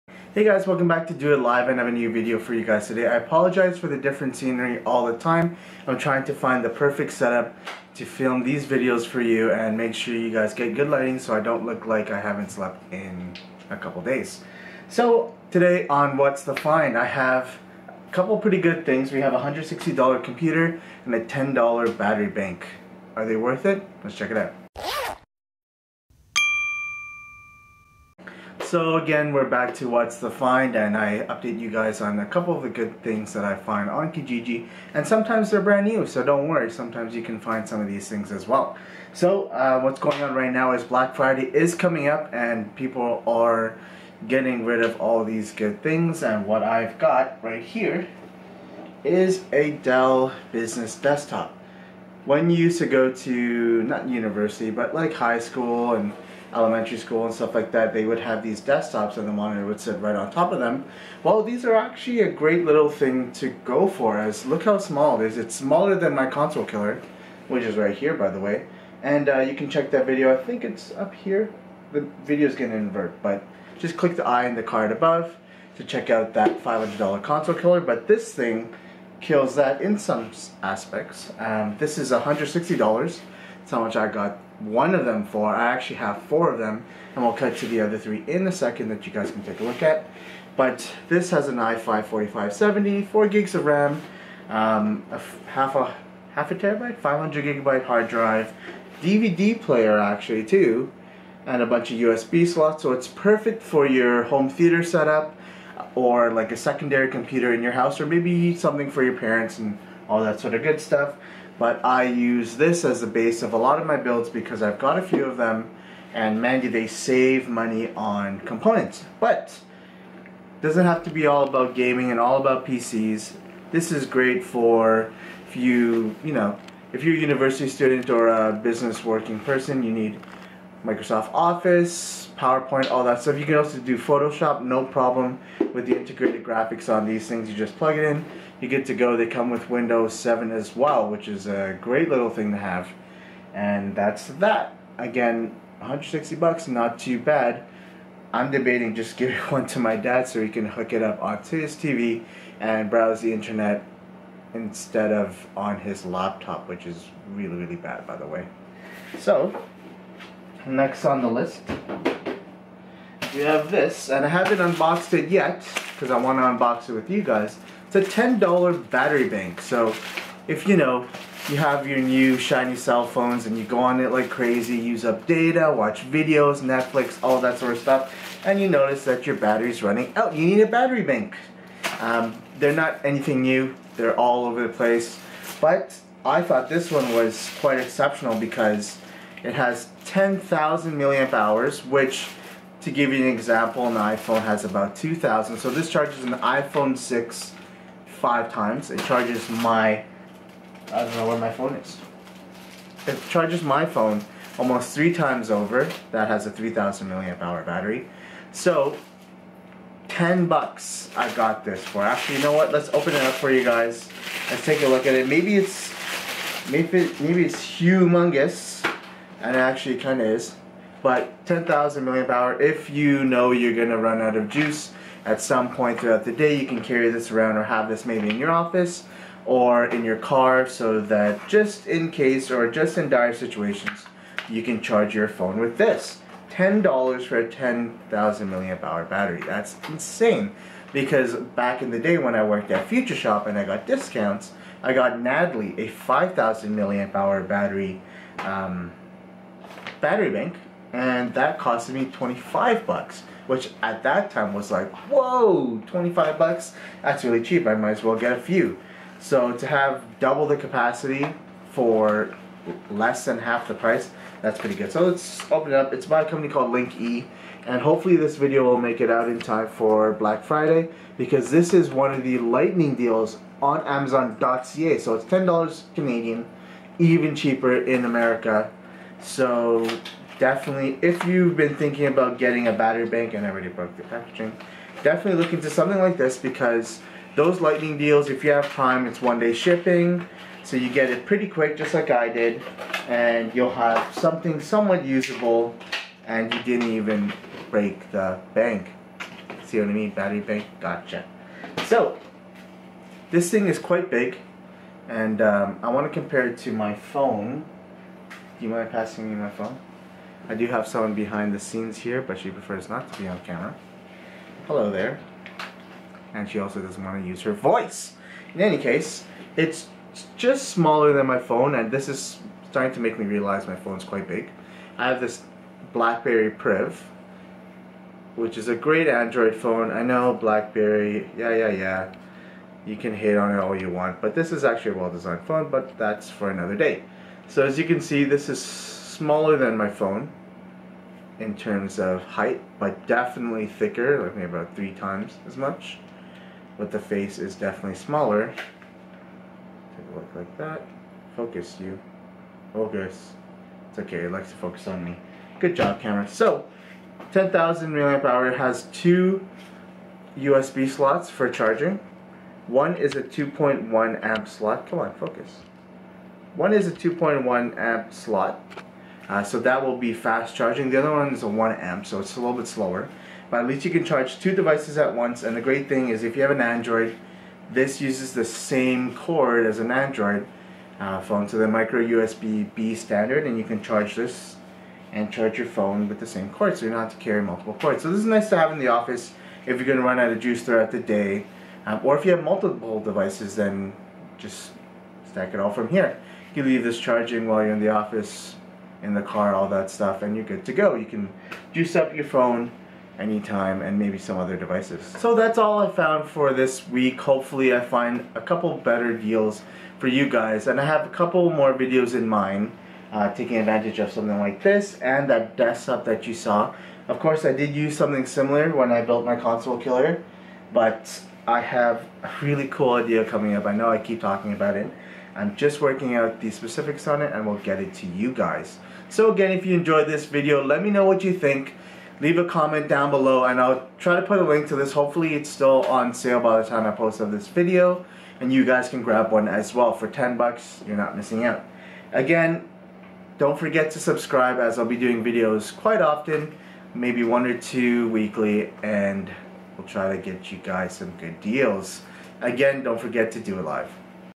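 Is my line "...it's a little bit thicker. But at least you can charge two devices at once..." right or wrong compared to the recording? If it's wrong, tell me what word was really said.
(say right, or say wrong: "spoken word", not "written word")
wrong: "slower", not "thicker".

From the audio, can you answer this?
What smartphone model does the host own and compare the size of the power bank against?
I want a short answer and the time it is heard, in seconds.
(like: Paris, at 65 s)
BlackBerry Priv, at 325 s.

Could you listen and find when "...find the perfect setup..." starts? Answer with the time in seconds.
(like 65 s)
6 s.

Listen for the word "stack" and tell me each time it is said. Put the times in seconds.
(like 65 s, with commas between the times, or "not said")
395 s.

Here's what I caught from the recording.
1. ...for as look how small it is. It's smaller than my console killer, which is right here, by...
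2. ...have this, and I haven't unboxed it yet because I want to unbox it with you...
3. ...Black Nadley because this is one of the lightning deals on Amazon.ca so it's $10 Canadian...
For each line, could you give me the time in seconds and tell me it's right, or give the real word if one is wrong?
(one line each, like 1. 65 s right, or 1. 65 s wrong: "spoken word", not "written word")
1. 63 s right
2. 163 s right
3. 270 s wrong: "Friday", not "Nadley".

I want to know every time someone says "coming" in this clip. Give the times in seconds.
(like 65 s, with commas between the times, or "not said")
41 s, 423 s.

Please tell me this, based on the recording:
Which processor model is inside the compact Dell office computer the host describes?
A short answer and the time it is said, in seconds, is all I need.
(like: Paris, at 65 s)
i5-4570, at 91 s.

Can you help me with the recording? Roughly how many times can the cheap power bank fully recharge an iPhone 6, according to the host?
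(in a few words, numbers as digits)
5.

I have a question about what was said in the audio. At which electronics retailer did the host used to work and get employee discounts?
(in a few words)
Future Shop.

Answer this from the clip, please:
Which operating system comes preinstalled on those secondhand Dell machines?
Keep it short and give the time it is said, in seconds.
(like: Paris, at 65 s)
Windows 7, at 139 s.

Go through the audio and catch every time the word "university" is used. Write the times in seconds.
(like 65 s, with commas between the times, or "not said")
54 s, 127 s.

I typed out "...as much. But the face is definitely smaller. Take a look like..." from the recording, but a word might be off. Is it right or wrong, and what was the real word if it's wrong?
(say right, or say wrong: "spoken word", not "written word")
right.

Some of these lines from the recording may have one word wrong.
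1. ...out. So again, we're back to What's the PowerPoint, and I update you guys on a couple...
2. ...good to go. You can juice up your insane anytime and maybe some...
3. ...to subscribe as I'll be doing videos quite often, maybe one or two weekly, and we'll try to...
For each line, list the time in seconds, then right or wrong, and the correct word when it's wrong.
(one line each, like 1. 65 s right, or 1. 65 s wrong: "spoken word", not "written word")
1. 24 s wrong: "Find", not "PowerPoint"
2. 400 s wrong: "phone", not "insane"
3. 443 s right.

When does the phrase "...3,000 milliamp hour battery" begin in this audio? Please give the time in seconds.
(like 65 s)
206 s.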